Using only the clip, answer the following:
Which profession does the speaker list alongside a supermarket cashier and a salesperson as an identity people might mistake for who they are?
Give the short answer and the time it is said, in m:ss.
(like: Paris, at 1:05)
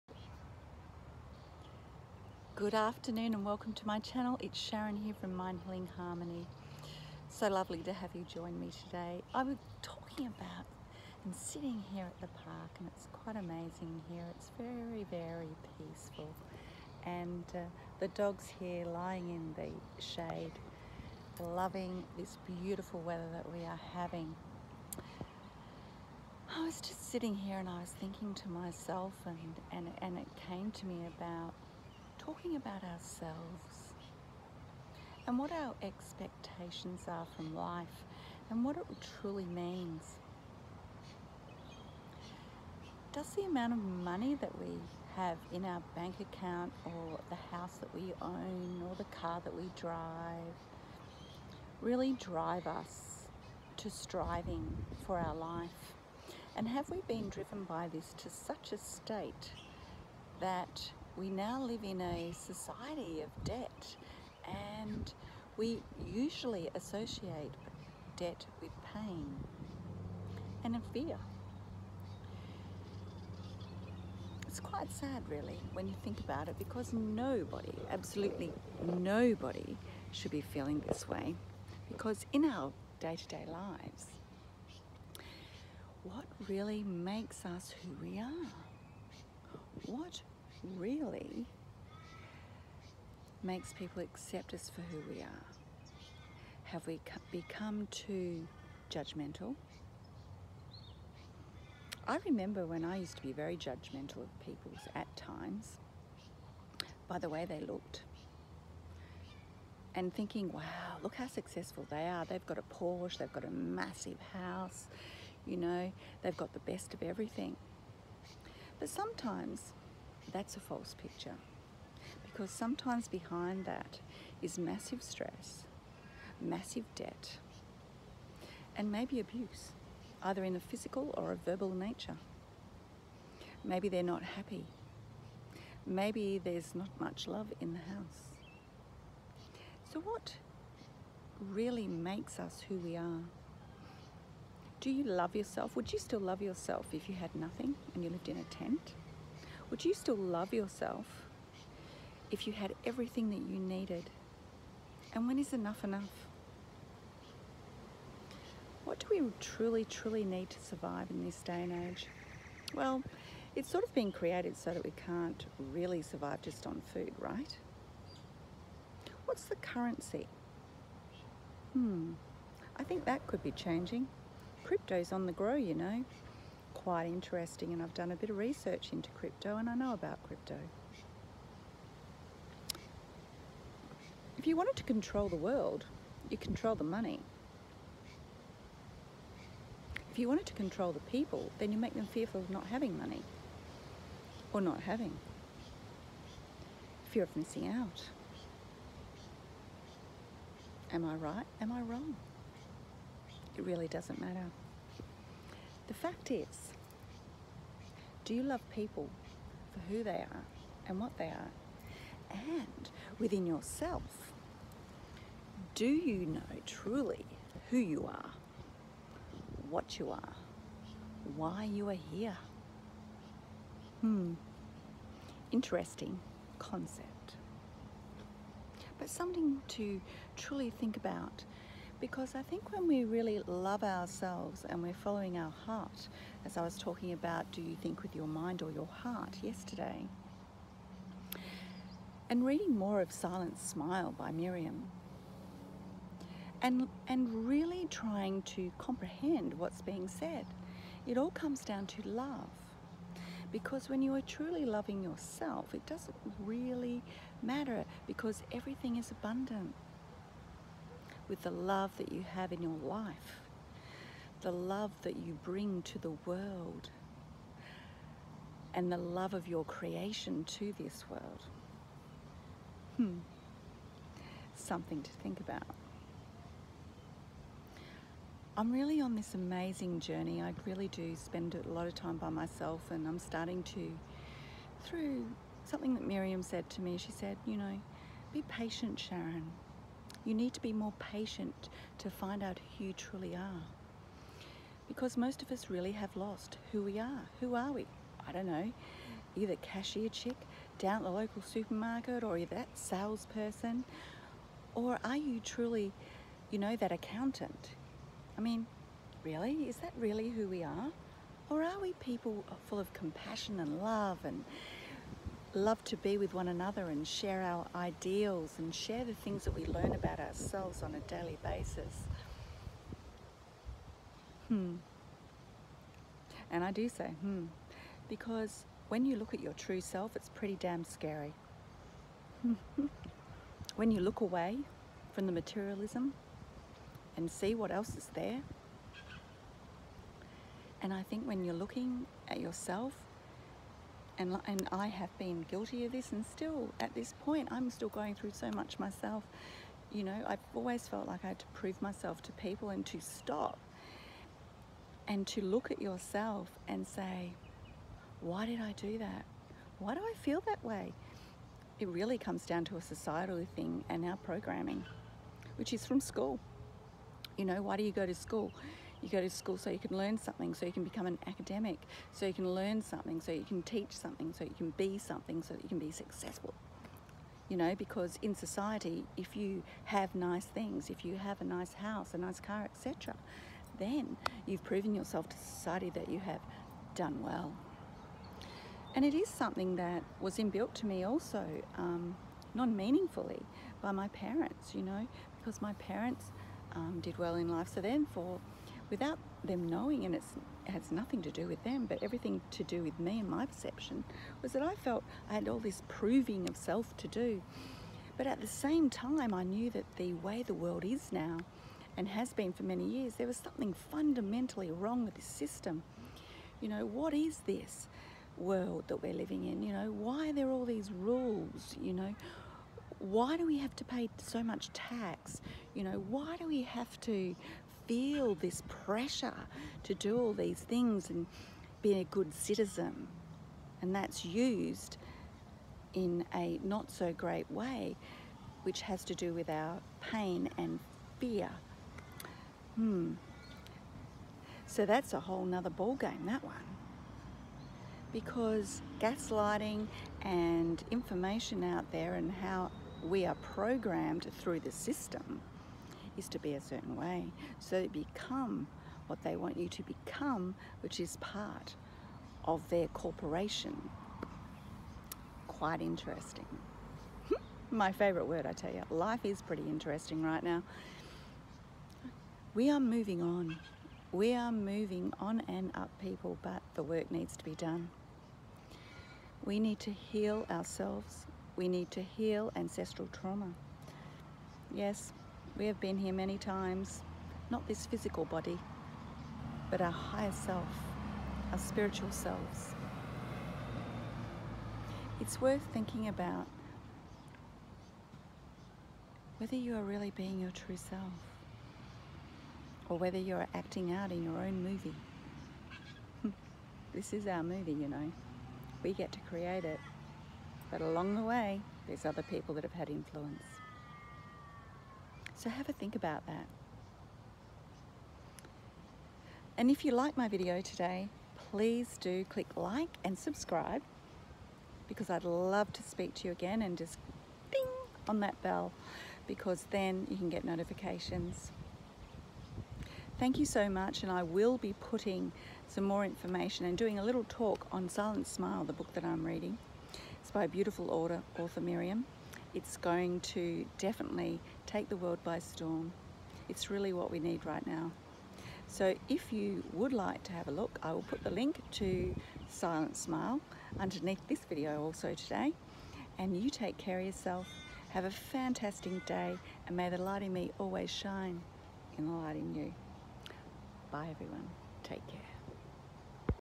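Accountant, at 5:06.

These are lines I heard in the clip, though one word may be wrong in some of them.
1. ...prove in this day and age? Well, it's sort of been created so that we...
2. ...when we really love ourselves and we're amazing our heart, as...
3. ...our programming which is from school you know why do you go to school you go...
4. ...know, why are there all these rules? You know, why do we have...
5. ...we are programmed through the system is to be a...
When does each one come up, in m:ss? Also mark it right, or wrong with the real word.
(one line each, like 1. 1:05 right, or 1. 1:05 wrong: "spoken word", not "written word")
1. 2:40 wrong: "survive", not "prove"
2. 3:52 wrong: "following", not "amazing"
3. 6:04 right
4. 6:59 right
5. 7:33 right.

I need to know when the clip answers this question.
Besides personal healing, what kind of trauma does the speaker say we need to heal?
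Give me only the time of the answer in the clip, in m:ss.
8:02.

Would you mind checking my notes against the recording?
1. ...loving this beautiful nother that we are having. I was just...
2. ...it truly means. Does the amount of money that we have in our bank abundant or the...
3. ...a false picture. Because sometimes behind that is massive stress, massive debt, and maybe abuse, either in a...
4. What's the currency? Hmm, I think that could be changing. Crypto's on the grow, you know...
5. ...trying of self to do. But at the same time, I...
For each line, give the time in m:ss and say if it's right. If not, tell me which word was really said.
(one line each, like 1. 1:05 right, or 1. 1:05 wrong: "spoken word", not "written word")
1. 0:21 wrong: "weather", not "nother"
2. 0:38 wrong: "account", not "abundant"
3. 2:00 right
4. 2:49 right
5. 6:45 wrong: "proving", not "trying".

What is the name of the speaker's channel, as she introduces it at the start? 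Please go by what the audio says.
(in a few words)
Mind Healing Harmony.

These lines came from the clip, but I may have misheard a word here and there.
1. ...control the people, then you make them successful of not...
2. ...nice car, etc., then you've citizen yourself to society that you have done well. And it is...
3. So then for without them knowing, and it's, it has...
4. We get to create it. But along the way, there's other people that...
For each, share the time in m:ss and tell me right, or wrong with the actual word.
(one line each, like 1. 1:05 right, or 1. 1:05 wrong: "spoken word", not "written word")
1. 3:10 wrong: "fearful", not "successful"
2. 6:22 wrong: "proven", not "citizen"
3. 6:37 right
4. 8:28 right.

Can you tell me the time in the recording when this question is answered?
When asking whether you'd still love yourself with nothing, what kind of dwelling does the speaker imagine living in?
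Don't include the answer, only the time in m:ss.
2:28.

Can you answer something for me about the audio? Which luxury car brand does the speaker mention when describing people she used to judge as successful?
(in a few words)
Porsche.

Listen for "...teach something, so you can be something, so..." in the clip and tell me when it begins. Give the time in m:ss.
6:13.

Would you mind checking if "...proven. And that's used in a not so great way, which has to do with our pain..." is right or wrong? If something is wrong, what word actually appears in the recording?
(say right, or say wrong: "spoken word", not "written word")
wrong: "citizen", not "proven".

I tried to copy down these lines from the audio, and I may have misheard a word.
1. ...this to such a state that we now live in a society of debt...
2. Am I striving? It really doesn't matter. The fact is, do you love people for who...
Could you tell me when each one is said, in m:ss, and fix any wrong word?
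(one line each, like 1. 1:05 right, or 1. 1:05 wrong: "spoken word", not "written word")
1. 0:57 right
2. 3:21 wrong: "wrong", not "striving".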